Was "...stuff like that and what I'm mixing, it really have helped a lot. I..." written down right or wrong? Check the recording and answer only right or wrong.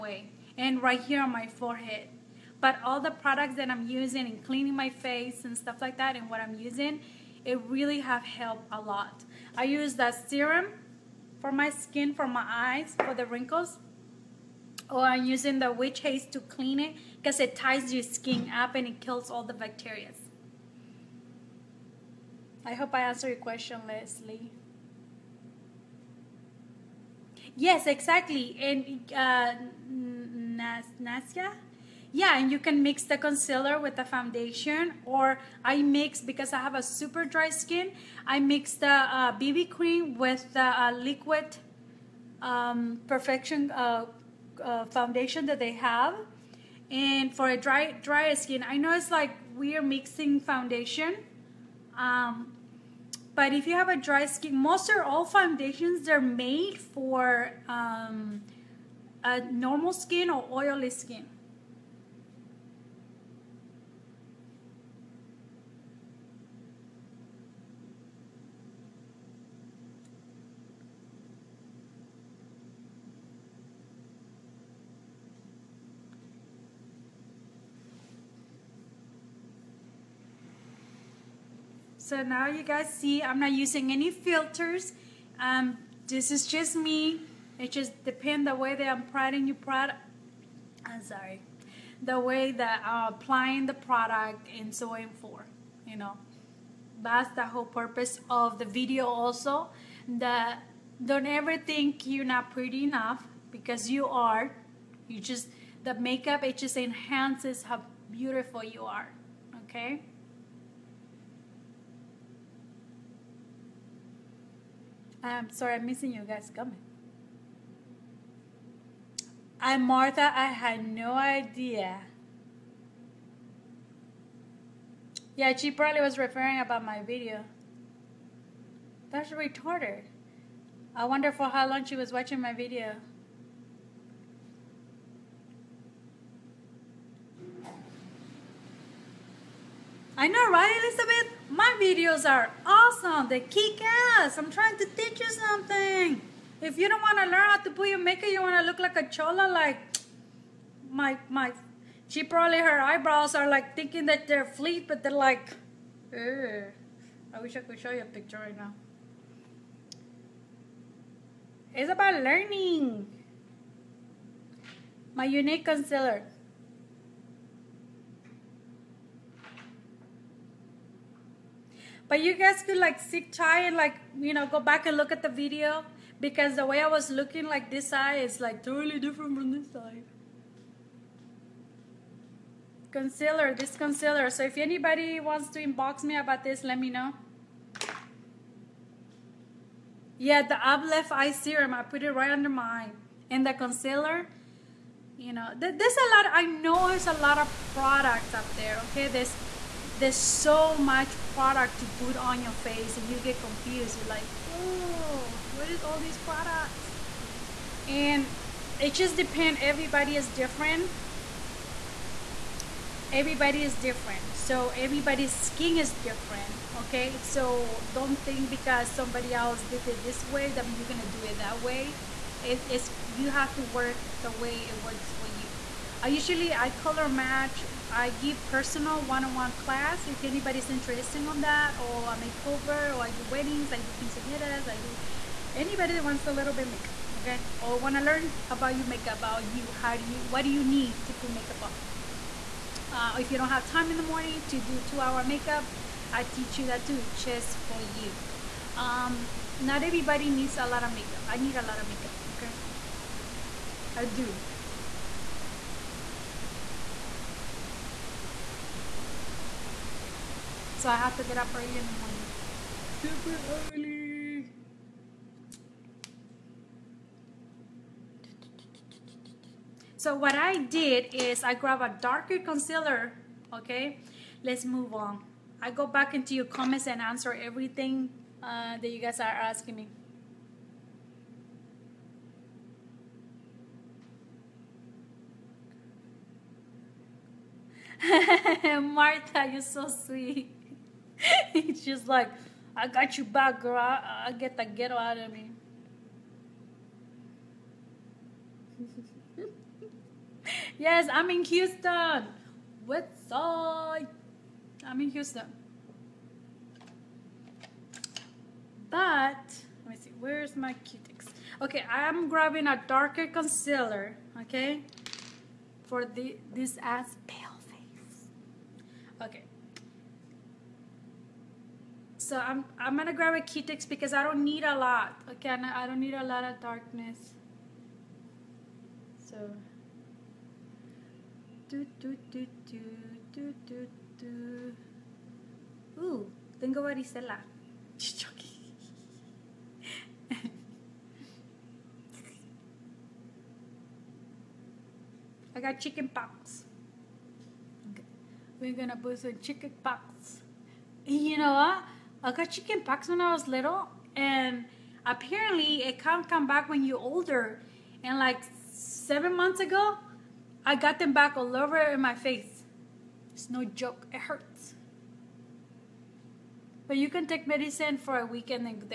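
wrong.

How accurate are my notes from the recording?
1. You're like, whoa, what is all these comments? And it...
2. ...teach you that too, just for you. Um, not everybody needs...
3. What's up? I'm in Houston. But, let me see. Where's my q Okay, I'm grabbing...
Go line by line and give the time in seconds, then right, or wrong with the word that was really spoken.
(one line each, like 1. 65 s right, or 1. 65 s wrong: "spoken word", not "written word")
1. 203 s wrong: "products", not "comments"
2. 246 s right
3. 302 s right.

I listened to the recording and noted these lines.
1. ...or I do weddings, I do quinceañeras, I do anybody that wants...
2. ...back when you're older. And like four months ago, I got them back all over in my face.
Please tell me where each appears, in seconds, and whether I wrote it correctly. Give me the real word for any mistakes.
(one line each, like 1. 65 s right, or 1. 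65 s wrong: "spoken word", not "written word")
1. 232 s right
2. 356 s wrong: "seven", not "four".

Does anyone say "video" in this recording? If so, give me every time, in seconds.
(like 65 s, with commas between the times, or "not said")
98 s, 127 s, 132 s, 141 s, 175 s.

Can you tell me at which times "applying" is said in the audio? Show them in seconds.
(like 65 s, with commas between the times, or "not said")
89 s, 93 s.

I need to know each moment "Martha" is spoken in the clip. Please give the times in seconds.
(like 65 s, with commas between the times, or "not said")
119 s, 288 s.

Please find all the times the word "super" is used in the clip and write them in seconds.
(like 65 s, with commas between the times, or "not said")
36 s, 262 s.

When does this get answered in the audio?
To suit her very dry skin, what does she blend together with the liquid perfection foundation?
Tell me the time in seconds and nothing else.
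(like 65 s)
39 s.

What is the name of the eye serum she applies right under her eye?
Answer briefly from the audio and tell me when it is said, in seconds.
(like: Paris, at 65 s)
Uplift, at 190 s.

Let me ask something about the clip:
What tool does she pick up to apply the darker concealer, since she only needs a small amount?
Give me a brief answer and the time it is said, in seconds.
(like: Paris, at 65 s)
Q-Tips, at 323 s.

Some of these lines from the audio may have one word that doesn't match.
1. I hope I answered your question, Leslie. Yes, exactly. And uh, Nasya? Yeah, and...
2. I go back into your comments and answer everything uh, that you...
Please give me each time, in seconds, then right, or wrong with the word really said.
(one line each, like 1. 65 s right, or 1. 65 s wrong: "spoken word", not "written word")
1. 22 s right
2. 275 s right.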